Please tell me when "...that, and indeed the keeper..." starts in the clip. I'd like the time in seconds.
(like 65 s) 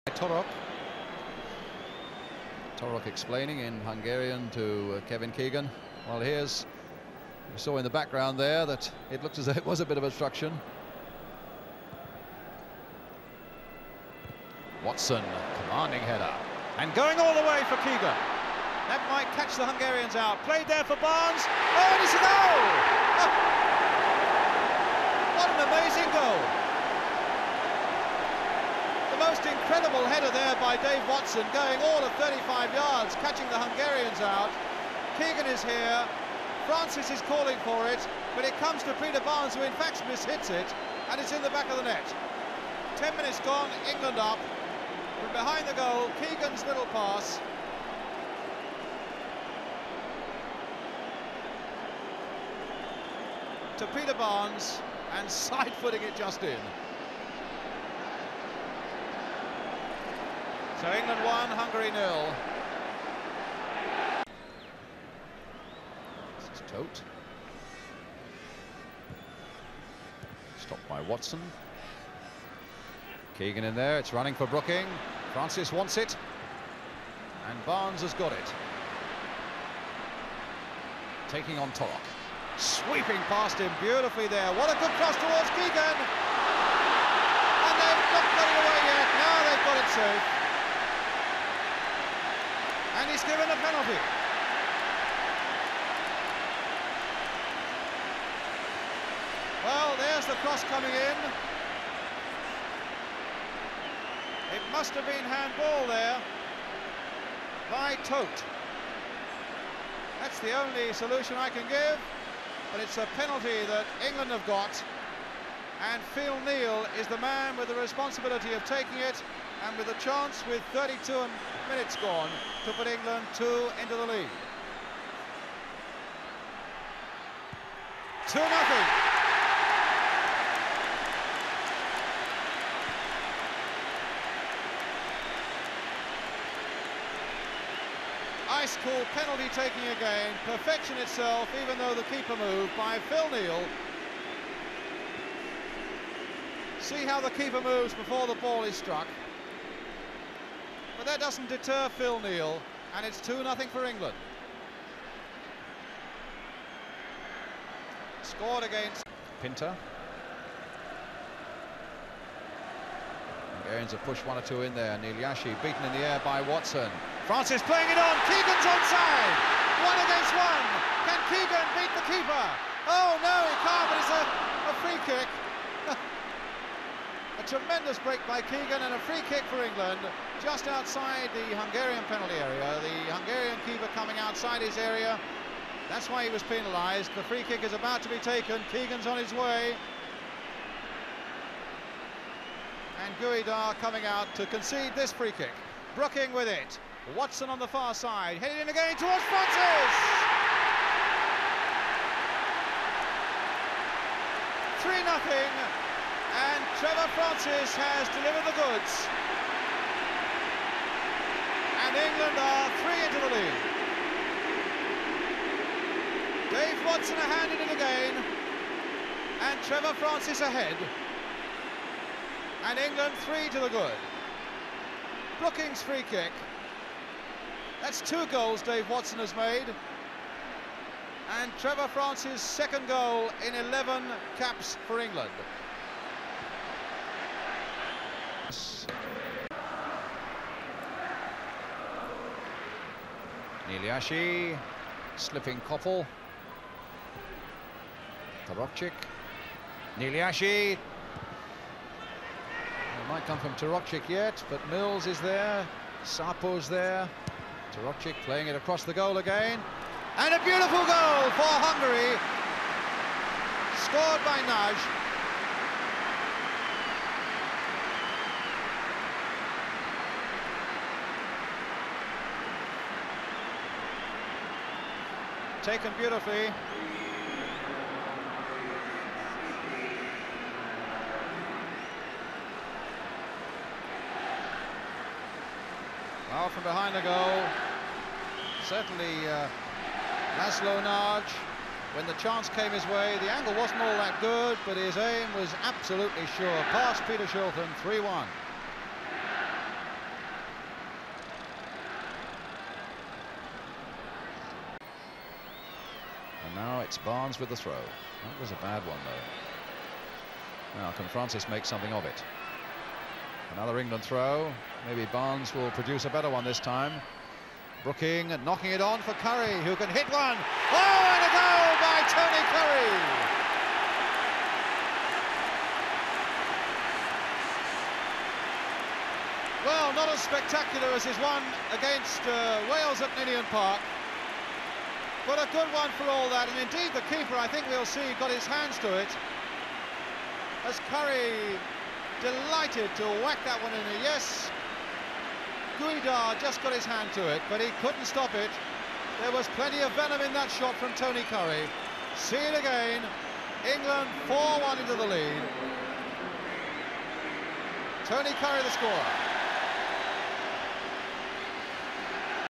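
336 s.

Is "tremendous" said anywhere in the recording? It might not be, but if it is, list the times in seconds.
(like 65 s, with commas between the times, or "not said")
177 s.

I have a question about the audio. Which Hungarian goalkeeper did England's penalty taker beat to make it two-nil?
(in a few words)
Pinter.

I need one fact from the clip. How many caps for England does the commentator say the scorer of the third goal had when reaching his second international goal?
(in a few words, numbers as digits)
11.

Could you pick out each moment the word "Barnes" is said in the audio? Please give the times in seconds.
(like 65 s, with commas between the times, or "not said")
20 s, 39 s, 54 s, 77 s, 306 s, 315 s.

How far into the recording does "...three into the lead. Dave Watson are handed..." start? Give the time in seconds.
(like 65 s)
212 s.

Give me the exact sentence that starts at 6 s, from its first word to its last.
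Well, here's, you saw in the background there that it looked as though it was a bit of obstruction.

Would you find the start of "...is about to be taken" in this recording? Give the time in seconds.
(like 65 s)
187 s.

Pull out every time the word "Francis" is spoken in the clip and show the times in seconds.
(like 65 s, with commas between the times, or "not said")
36 s, 75 s, 167 s, 199 s, 207 s, 219 s, 231 s, 311 s.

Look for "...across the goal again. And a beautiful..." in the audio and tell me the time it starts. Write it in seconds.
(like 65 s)
258 s.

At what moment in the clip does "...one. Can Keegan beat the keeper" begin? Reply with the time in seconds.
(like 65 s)
170 s.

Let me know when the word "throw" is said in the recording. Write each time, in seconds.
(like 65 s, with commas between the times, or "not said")
307 s, 314 s.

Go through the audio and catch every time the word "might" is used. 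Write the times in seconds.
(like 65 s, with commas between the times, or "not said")
19 s, 253 s.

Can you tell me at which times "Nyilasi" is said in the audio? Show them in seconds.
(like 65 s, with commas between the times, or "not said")
164 s, 243 s, 249 s.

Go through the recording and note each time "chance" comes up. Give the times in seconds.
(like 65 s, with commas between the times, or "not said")
119 s, 292 s.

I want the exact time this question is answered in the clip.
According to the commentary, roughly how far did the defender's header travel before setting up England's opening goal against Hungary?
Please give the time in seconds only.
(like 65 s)
32 s.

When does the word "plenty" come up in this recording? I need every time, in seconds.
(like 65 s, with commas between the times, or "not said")
349 s.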